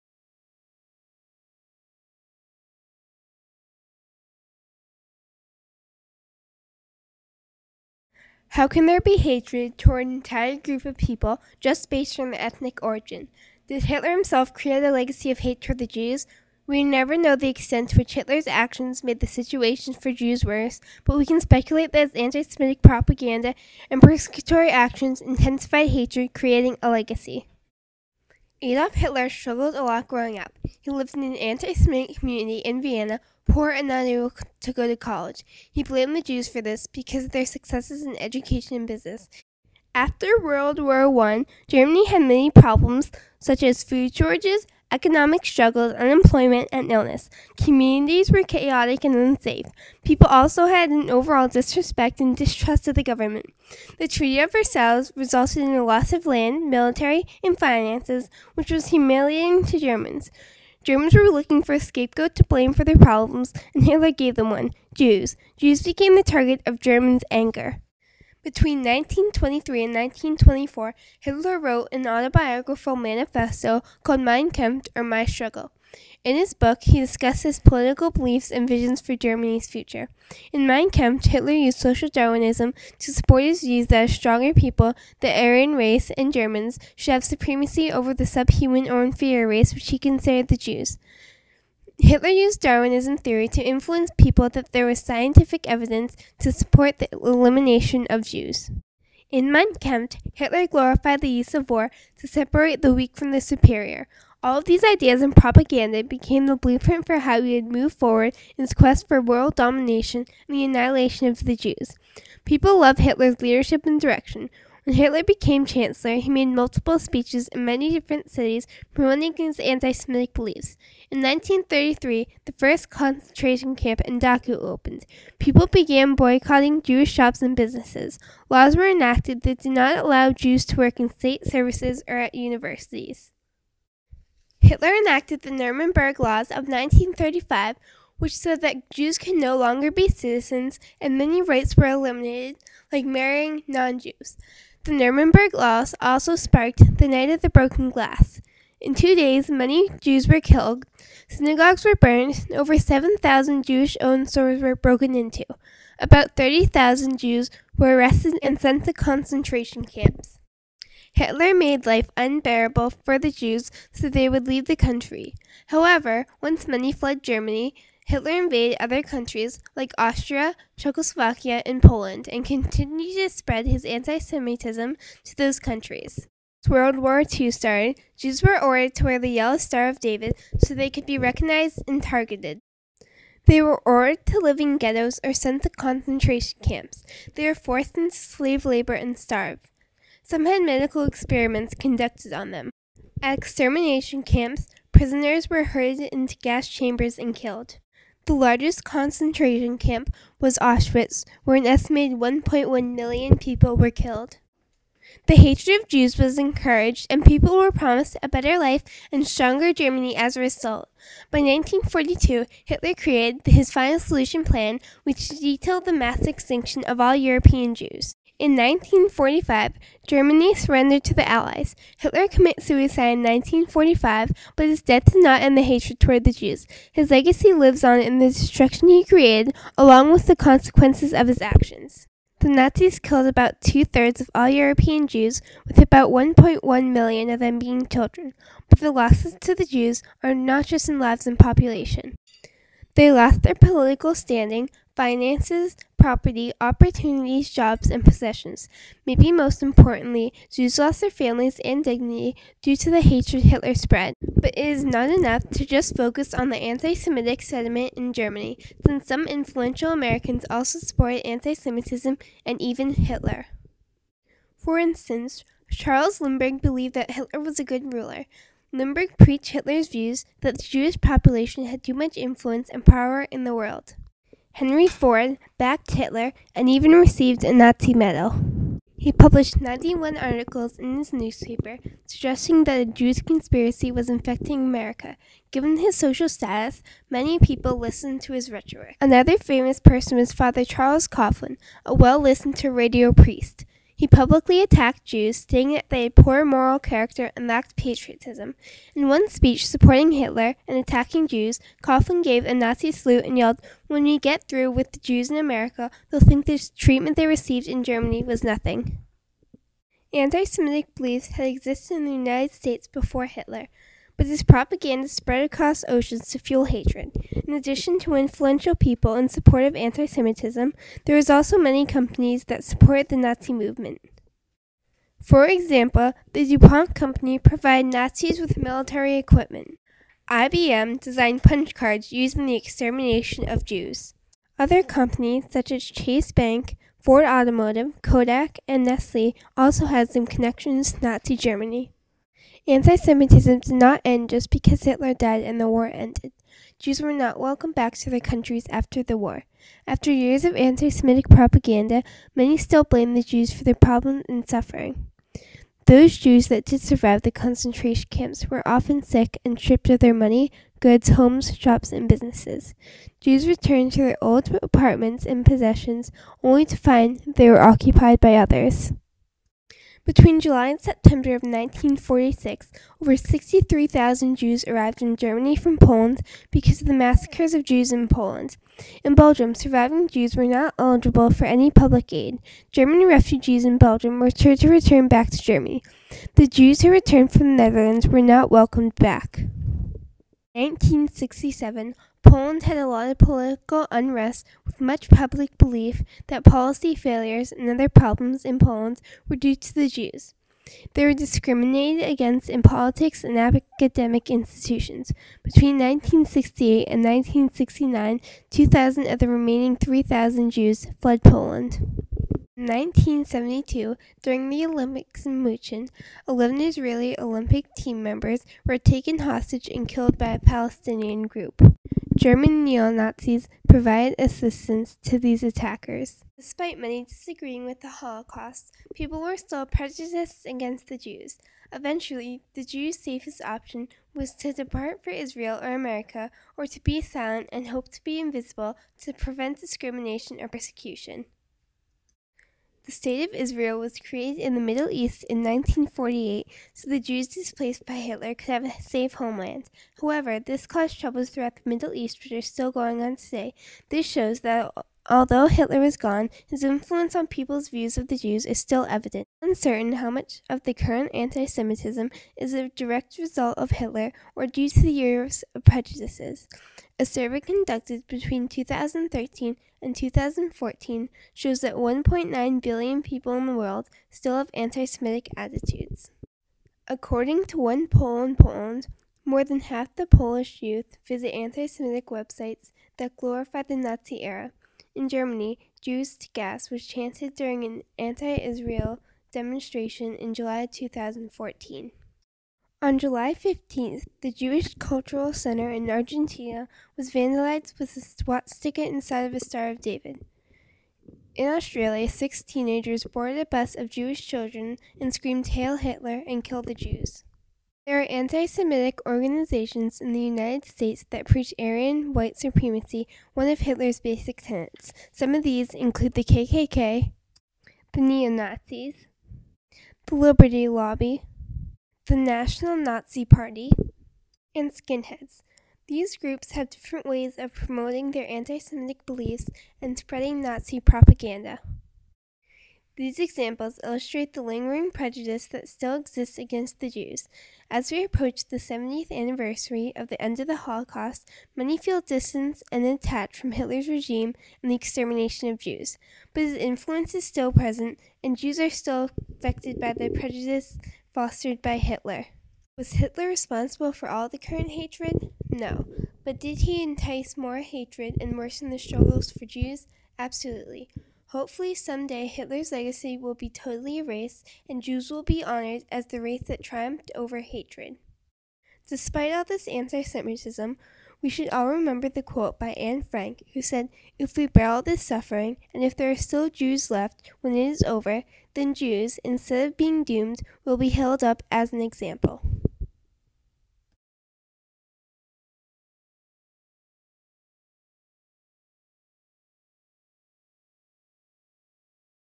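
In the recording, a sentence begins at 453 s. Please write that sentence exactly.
This shows that Although Hitler is gone, his influence on people's views of the Jews is still evident.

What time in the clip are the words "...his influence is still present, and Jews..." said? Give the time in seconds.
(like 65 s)
546 s.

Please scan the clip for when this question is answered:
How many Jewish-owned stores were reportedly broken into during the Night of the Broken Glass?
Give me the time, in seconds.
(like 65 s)
152 s.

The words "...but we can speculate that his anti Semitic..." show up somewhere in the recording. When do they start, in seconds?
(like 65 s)
21 s.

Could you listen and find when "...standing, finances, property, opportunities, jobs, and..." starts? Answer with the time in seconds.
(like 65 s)
244 s.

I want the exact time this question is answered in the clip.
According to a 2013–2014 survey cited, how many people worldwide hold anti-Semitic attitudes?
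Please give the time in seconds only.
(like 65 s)
471 s.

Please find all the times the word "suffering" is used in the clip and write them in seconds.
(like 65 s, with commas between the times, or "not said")
354 s, 575 s.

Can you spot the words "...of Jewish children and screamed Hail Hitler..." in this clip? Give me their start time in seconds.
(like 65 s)
503 s.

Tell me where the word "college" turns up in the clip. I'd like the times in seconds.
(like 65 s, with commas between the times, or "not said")
34 s.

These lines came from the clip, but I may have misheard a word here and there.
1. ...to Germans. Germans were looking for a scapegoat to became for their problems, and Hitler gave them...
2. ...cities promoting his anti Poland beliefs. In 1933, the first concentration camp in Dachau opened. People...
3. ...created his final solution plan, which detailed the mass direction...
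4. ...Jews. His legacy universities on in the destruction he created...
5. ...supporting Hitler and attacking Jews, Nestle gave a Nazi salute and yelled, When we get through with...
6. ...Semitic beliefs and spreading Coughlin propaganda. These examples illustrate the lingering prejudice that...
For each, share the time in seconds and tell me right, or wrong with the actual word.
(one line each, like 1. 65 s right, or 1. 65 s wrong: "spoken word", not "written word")
1. 59 s wrong: "blame", not "became"
2. 118 s wrong: "Semitic", not "Poland"
3. 212 s wrong: "extinction", not "direction"
4. 226 s wrong: "lives", not "universities"
5. 299 s wrong: "Coughlin", not "Nestle"
6. 528 s wrong: "Nazi", not "Coughlin".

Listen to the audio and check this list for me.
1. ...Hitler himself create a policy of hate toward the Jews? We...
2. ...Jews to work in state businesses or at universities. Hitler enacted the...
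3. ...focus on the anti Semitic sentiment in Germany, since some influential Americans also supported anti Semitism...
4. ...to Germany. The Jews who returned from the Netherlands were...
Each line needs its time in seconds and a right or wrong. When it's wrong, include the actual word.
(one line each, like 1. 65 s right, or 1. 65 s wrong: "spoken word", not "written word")
1. 13 s wrong: "legacy", not "policy"
2. 130 s wrong: "services", not "businesses"
3. 255 s right
4. 385 s right.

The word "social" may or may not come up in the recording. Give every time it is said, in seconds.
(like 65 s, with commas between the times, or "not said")
81 s, 285 s.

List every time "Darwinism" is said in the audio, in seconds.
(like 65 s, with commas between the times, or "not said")
82 s, 92 s.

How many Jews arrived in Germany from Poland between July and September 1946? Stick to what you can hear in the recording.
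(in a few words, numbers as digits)
over 63,000.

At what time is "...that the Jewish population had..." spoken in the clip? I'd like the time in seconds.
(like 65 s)
270 s.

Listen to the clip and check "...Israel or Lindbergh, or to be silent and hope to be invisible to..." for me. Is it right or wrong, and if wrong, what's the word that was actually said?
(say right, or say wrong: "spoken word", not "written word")
wrong: "America", not "Lindbergh".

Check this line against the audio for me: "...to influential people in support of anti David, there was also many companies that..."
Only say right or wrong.
wrong.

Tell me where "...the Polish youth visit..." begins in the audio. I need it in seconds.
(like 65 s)
479 s.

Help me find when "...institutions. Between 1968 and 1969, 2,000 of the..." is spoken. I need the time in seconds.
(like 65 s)
404 s.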